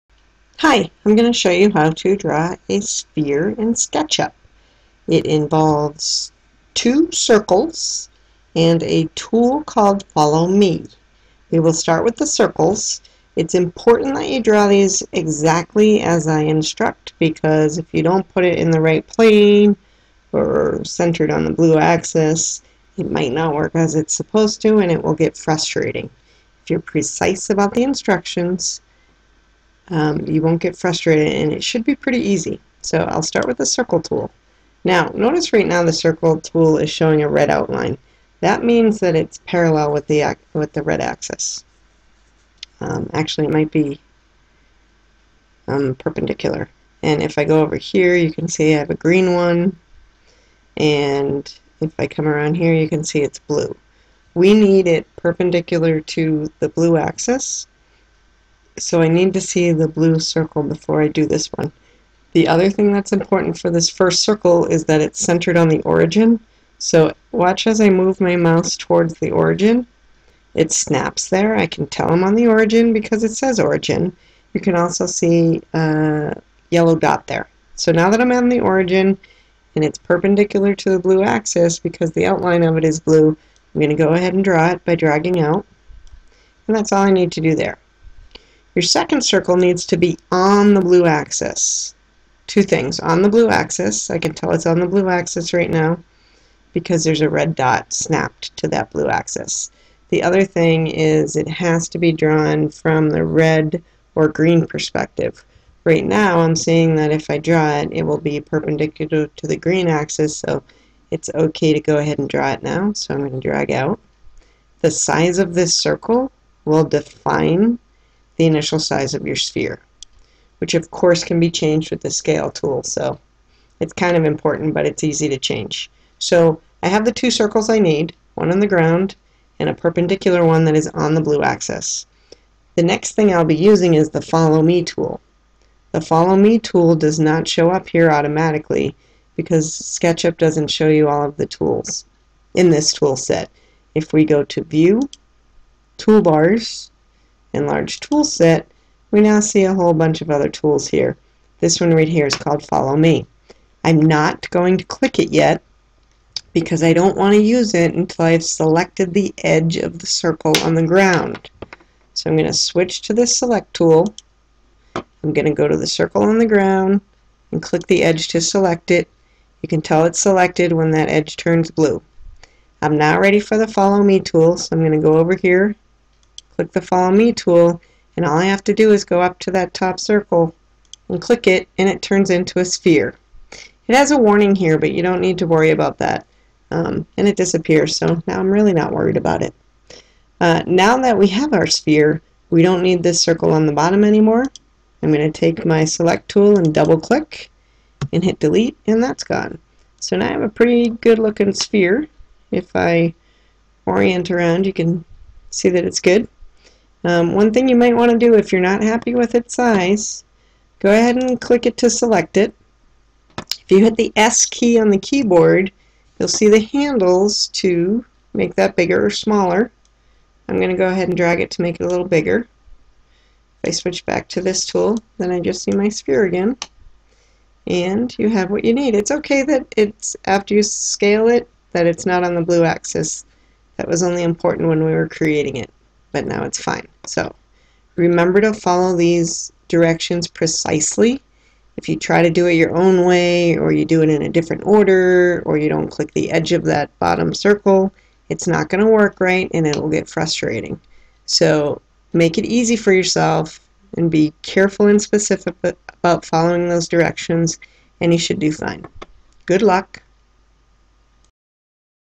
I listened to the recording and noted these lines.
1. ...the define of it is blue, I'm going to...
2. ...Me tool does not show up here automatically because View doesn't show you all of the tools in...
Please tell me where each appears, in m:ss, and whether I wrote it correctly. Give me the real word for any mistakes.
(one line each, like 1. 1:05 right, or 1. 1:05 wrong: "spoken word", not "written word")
1. 1:22 wrong: "outline", not "define"
2. 2:16 wrong: "SketchUp", not "View".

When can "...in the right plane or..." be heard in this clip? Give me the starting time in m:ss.
0:18.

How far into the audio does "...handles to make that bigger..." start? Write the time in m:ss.
3:36.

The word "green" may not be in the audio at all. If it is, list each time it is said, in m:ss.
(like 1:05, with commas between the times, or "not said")
0:48, 1:44, 1:49.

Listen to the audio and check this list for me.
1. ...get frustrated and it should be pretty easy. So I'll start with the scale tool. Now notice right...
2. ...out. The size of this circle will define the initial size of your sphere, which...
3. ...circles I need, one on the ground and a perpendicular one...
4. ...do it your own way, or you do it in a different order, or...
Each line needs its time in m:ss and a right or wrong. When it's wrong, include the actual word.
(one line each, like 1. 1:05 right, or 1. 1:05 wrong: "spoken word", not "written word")
1. 0:30 wrong: "circle", not "scale"
2. 1:53 right
3. 2:07 right
4. 4:02 right.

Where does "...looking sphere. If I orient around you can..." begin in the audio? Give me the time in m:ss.
3:21.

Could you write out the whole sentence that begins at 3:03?
It has a warning here, but you don't need to worry about that.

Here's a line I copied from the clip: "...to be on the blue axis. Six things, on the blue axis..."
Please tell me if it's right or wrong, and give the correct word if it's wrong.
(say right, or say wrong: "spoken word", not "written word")
wrong: "Two", not "Six".